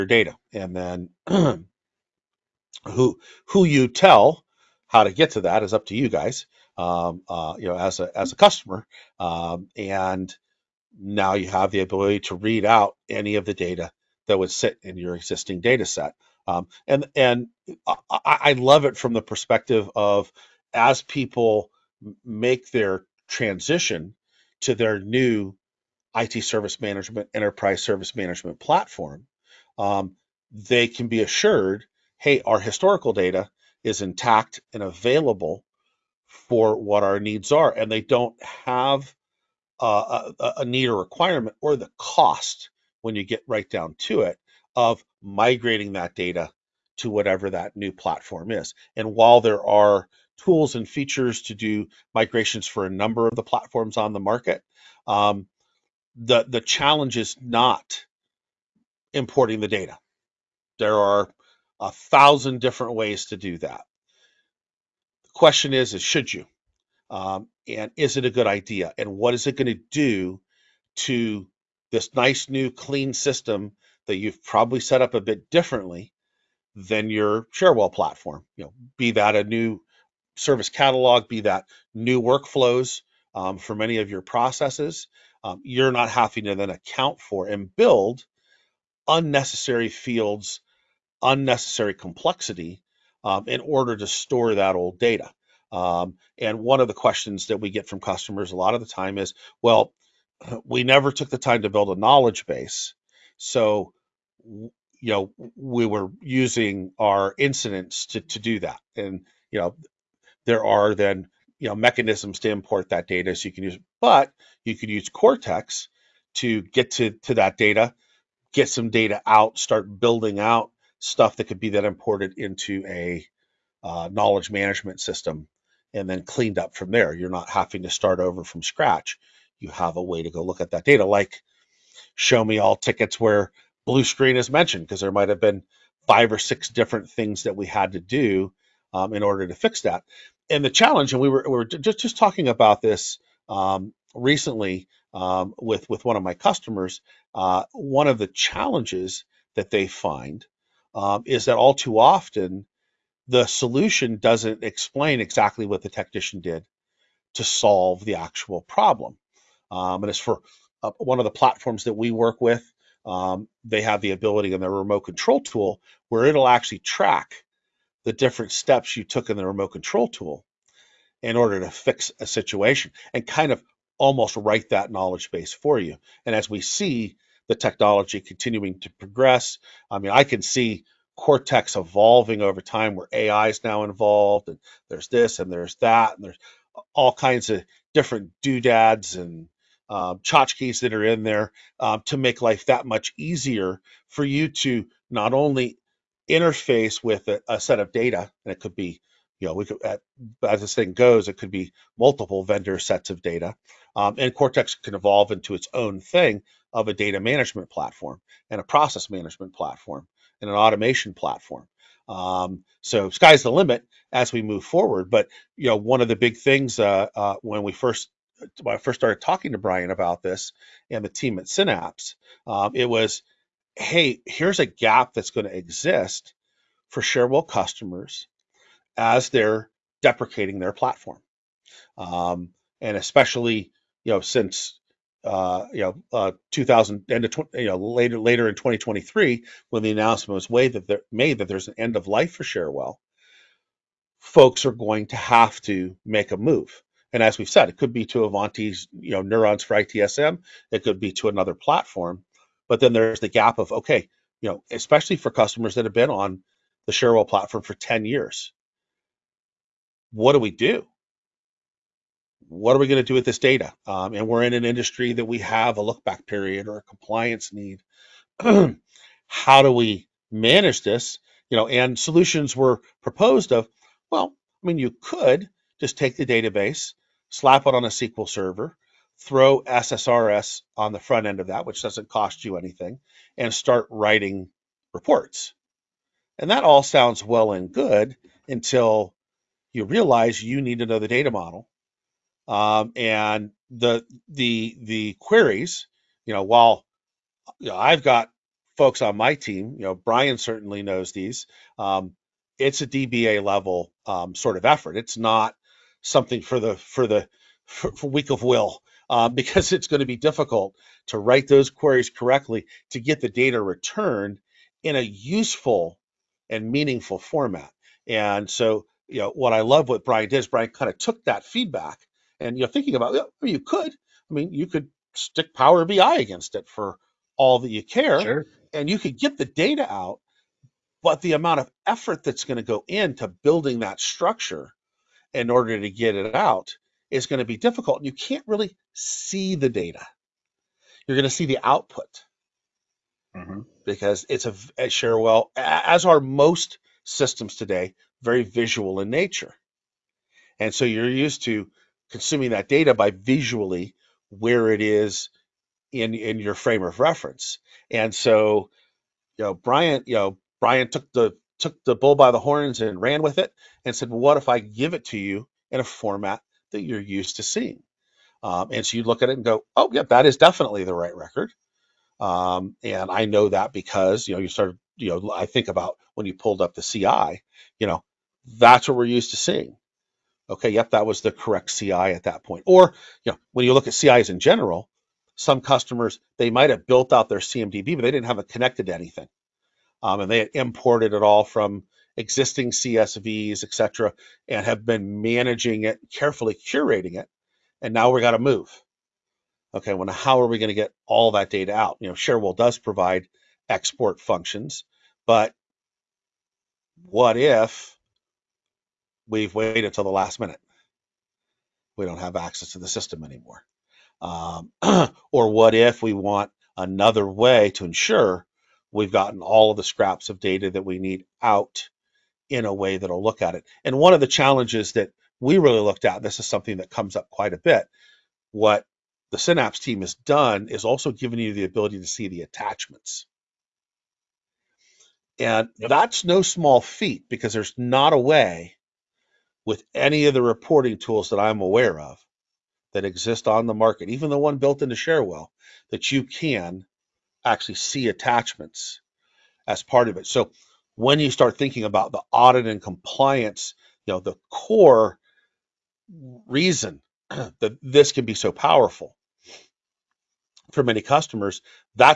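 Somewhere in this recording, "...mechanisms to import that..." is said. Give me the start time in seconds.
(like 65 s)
111 s.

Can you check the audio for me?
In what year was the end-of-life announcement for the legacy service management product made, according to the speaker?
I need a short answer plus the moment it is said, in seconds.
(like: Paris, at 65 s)
2023, at 238 s.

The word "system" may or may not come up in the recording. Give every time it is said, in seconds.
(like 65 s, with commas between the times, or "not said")
73 s, 125 s, 347 s, 412 s.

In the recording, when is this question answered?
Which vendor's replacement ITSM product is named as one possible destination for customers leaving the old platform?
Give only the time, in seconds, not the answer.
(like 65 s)
248 s.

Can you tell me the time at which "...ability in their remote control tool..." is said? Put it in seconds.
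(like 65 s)
164 s.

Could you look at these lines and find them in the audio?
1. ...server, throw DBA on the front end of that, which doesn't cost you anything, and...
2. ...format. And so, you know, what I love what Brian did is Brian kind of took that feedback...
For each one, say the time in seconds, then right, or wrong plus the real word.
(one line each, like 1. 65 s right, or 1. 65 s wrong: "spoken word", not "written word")
1. 278 s wrong: "SSRS", not "DBA"
2. 317 s right.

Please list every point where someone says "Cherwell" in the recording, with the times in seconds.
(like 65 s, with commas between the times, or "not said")
77 s, 227 s, 242 s, 256 s, 402 s.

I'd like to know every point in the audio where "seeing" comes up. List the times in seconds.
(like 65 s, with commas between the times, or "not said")
367 s, 379 s.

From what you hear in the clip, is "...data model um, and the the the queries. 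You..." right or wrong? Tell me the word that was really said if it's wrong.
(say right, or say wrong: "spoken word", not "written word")
right.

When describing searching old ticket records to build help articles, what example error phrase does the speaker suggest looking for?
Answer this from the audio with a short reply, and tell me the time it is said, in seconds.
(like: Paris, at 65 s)
blue screen, at 133 s.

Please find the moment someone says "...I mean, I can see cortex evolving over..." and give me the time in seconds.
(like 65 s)
179 s.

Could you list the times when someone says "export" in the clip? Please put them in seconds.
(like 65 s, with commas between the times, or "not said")
403 s.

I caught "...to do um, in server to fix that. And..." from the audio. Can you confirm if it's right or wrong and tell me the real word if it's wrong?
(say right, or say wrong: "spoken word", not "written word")
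wrong: "order", not "server".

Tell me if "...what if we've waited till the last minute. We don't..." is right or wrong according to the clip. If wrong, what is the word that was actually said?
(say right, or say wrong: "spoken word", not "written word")
right.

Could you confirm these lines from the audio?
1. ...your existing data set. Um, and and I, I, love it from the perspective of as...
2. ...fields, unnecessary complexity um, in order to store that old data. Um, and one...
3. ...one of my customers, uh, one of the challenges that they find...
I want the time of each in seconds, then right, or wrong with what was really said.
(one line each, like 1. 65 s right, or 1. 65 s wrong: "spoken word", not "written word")
1. 14 s right
2. 89 s right
3. 146 s right.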